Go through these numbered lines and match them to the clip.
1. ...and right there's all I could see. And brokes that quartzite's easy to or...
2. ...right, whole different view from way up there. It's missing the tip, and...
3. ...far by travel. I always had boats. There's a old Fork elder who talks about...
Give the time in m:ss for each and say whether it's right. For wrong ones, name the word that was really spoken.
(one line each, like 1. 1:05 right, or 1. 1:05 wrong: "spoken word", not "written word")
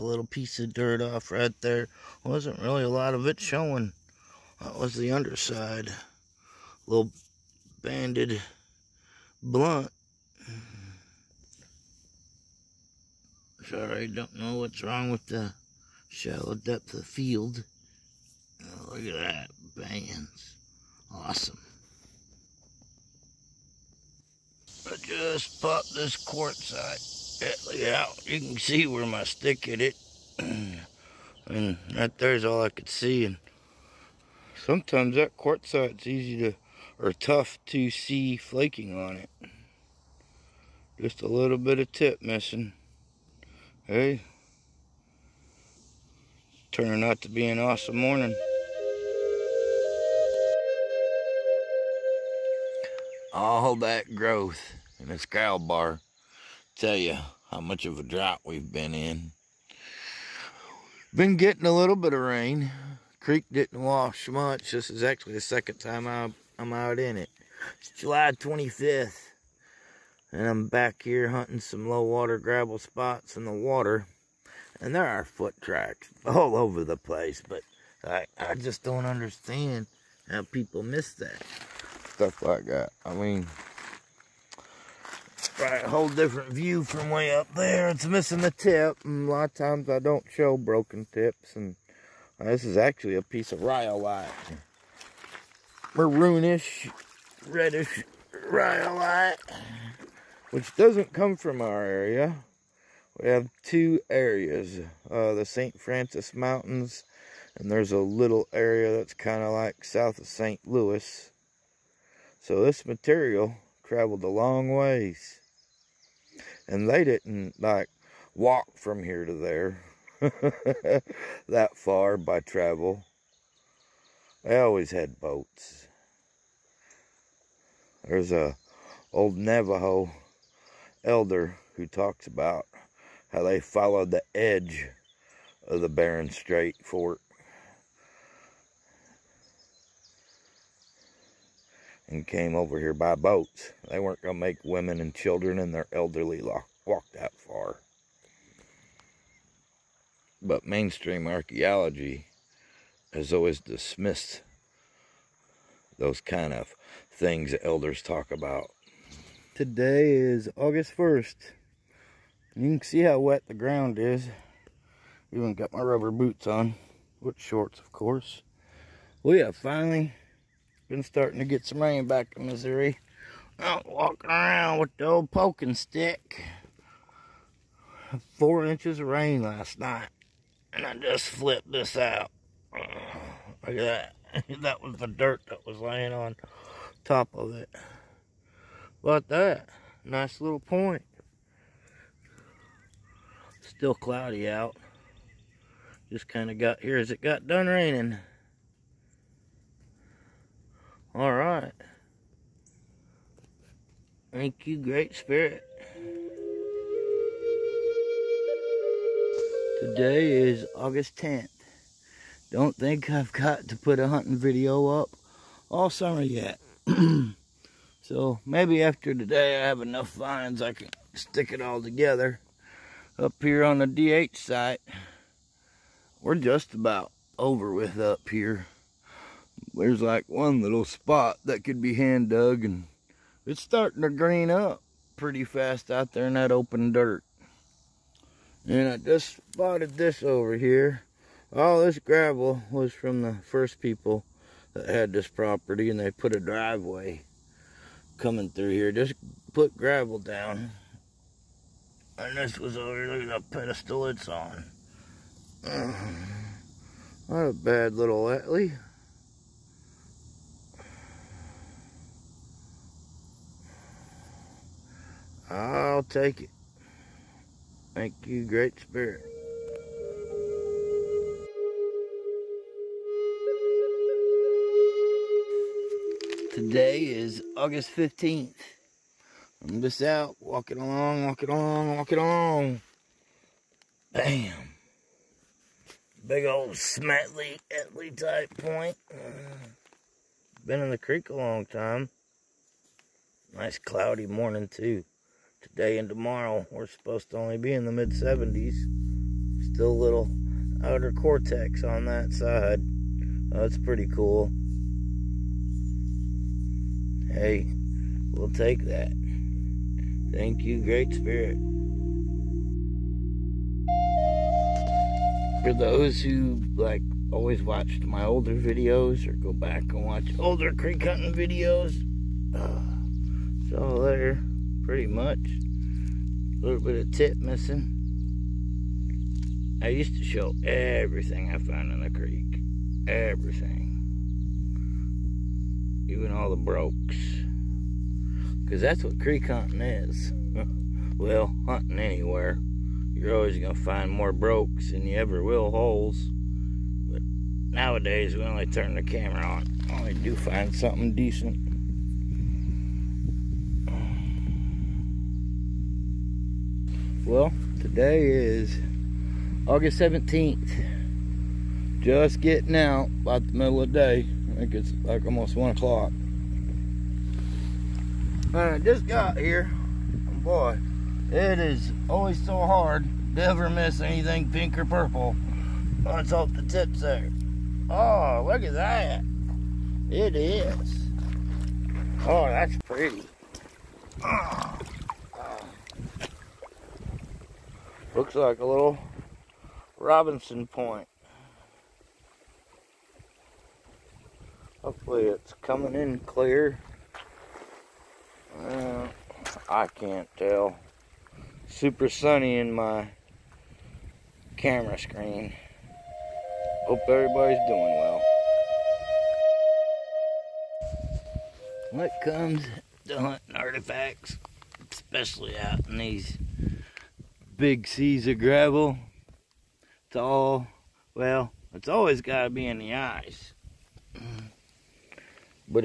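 1. 0:30 wrong: "sometimes", not "brokes"
2. 1:25 right
3. 2:01 wrong: "Navajo", not "Fork".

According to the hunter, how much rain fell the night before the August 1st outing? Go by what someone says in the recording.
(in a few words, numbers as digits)
4 inches.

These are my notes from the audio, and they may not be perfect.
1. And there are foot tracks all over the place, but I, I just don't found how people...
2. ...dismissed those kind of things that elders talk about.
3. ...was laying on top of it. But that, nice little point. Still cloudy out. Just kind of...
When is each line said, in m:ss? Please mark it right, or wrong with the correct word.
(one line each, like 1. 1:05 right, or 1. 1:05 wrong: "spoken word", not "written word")
1. 1:14 wrong: "understand", not "found"
2. 2:33 right
3. 3:05 right.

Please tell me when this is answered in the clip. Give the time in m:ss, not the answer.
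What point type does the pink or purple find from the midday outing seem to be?
6:29.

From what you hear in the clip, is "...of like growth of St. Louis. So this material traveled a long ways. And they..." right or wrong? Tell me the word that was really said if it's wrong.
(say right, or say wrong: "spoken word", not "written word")
wrong: "south", not "growth".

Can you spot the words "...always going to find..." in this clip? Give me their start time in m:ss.
5:43.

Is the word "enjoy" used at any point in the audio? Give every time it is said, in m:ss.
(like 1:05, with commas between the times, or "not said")
not said.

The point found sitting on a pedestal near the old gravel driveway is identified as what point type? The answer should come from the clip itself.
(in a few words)
Etley.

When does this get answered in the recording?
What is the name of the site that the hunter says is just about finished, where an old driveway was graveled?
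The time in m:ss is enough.
3:43.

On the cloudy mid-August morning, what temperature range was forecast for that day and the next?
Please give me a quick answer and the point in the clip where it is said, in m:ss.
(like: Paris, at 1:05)
mid 70s, at 4:57.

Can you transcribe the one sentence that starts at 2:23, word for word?
They weren't going to make women and children and their elderly walk that far.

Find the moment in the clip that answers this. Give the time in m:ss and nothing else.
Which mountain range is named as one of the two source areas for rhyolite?
1:45.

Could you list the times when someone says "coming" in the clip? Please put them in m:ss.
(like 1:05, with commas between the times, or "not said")
4:08, 6:35.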